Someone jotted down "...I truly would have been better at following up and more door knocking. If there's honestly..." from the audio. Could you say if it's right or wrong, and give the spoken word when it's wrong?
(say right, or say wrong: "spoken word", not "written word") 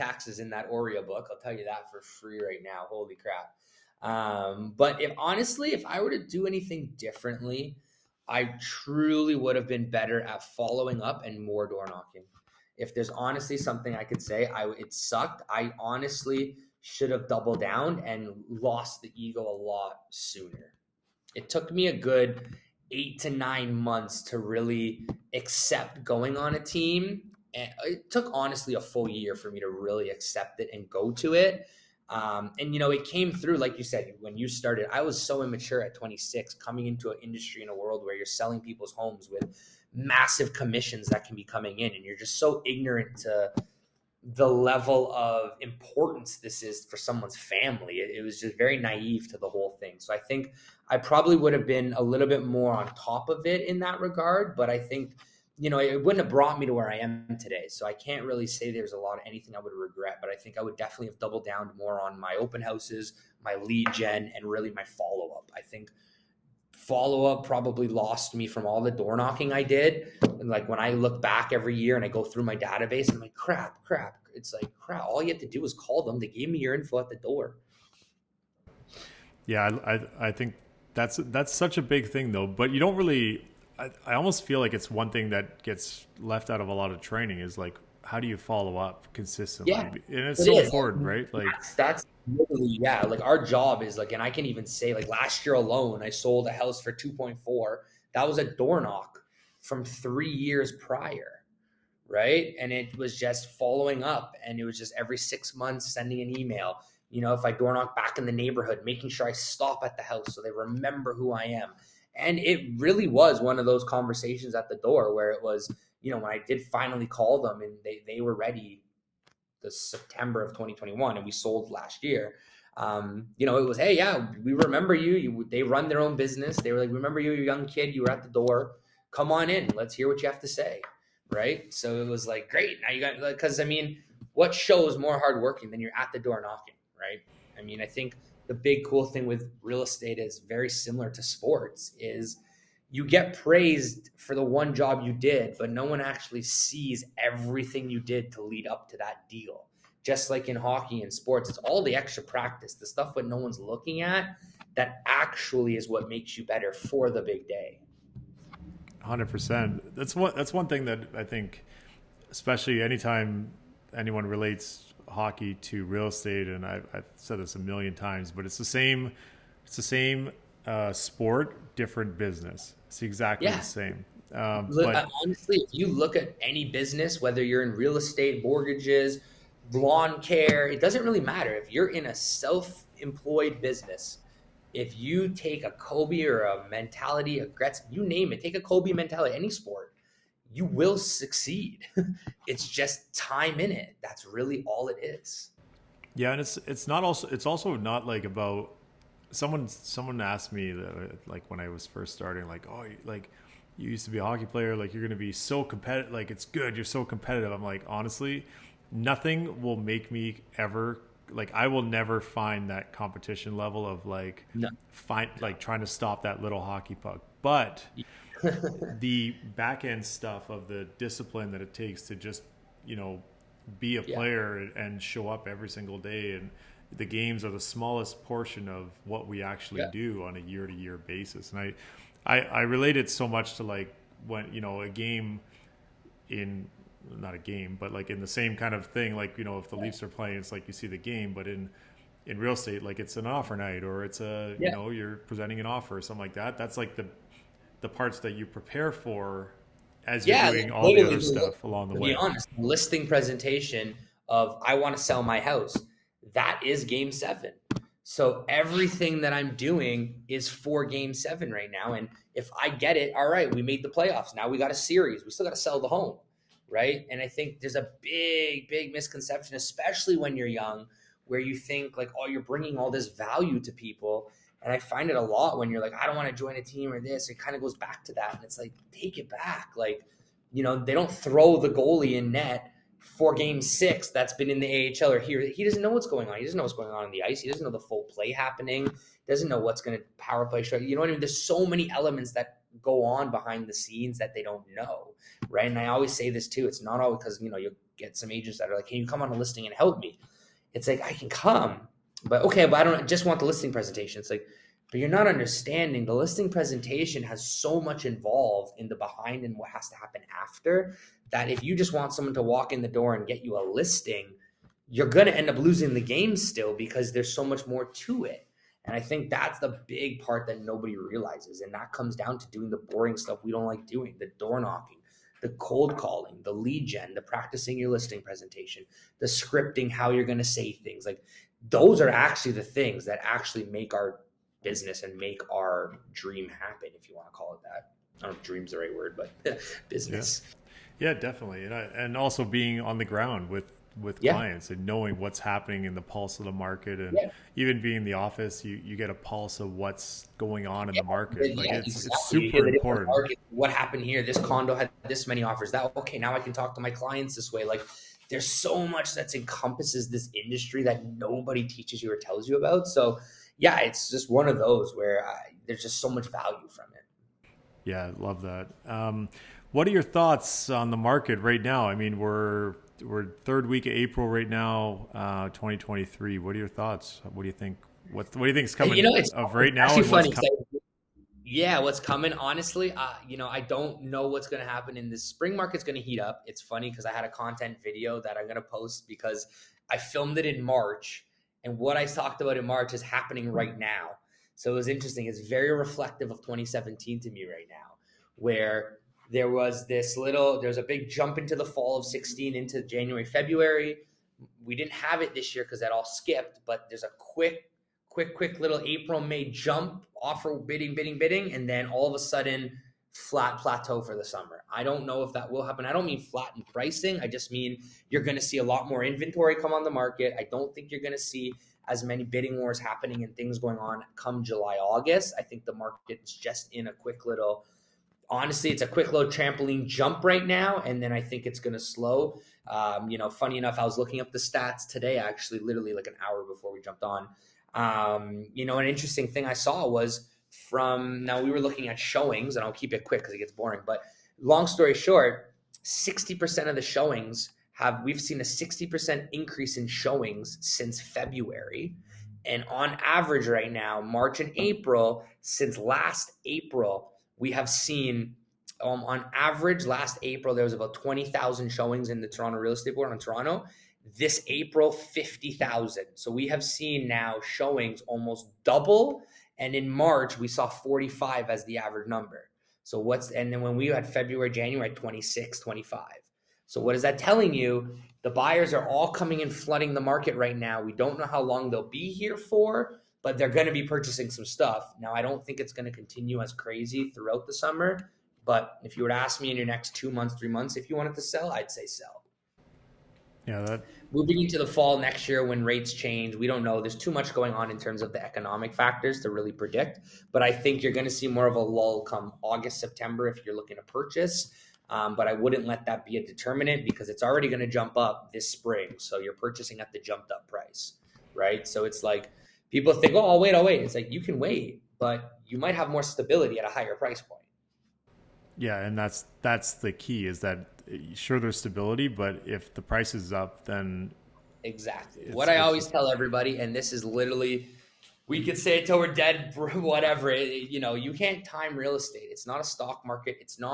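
right.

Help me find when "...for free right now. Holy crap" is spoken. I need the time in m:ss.
0:01.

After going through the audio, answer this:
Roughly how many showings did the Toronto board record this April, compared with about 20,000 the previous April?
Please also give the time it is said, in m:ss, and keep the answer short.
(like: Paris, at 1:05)
50,000, at 7:44.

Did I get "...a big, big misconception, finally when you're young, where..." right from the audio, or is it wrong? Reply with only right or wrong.
wrong.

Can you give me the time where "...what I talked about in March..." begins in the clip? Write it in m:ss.
6:31.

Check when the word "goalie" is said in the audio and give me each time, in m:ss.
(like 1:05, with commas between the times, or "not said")
4:41.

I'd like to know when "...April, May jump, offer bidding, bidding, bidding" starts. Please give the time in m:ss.
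6:48.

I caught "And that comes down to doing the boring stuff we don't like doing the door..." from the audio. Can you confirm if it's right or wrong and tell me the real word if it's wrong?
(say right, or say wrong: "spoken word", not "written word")
right.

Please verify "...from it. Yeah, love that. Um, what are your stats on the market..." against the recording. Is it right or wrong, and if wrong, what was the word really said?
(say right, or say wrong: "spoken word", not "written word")
wrong: "thoughts", not "stats".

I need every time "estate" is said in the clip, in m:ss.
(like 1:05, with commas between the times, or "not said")
2:19, 2:46, 2:57, 4:02, 7:42, 8:51.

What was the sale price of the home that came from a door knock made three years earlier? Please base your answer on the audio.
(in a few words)
2.4 million.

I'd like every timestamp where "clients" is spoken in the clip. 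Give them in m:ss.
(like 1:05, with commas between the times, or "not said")
5:44, 5:56.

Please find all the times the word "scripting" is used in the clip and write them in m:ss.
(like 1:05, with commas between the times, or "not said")
5:29.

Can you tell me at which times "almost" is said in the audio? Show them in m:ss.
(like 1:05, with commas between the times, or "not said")
1:24, 7:48.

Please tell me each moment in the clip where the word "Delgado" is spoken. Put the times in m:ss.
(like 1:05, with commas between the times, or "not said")
not said.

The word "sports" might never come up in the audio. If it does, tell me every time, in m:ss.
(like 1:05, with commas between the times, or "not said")
2:21, 2:31, 2:50, 3:09.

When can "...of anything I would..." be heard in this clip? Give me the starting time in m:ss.
0:59.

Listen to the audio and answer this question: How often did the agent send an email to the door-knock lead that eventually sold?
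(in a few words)
every 6 months.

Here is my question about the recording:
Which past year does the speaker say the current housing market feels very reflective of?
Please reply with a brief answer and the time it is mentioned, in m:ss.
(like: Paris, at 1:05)
2017, at 6:36.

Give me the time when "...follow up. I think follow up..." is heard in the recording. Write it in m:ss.
1:04.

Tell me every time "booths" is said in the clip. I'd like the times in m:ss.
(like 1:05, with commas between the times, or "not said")
not said.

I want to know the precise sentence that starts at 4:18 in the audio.
So everything that I'm doing is for game seven right now.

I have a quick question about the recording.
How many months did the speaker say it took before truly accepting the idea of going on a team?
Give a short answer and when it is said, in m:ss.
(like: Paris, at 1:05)
8 to 9 months, at 0:22.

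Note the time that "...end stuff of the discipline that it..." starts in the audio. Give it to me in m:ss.
3:39.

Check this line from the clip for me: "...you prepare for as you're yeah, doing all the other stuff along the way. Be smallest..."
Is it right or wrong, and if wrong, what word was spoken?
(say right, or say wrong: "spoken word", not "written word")
wrong: "honest", not "smallest".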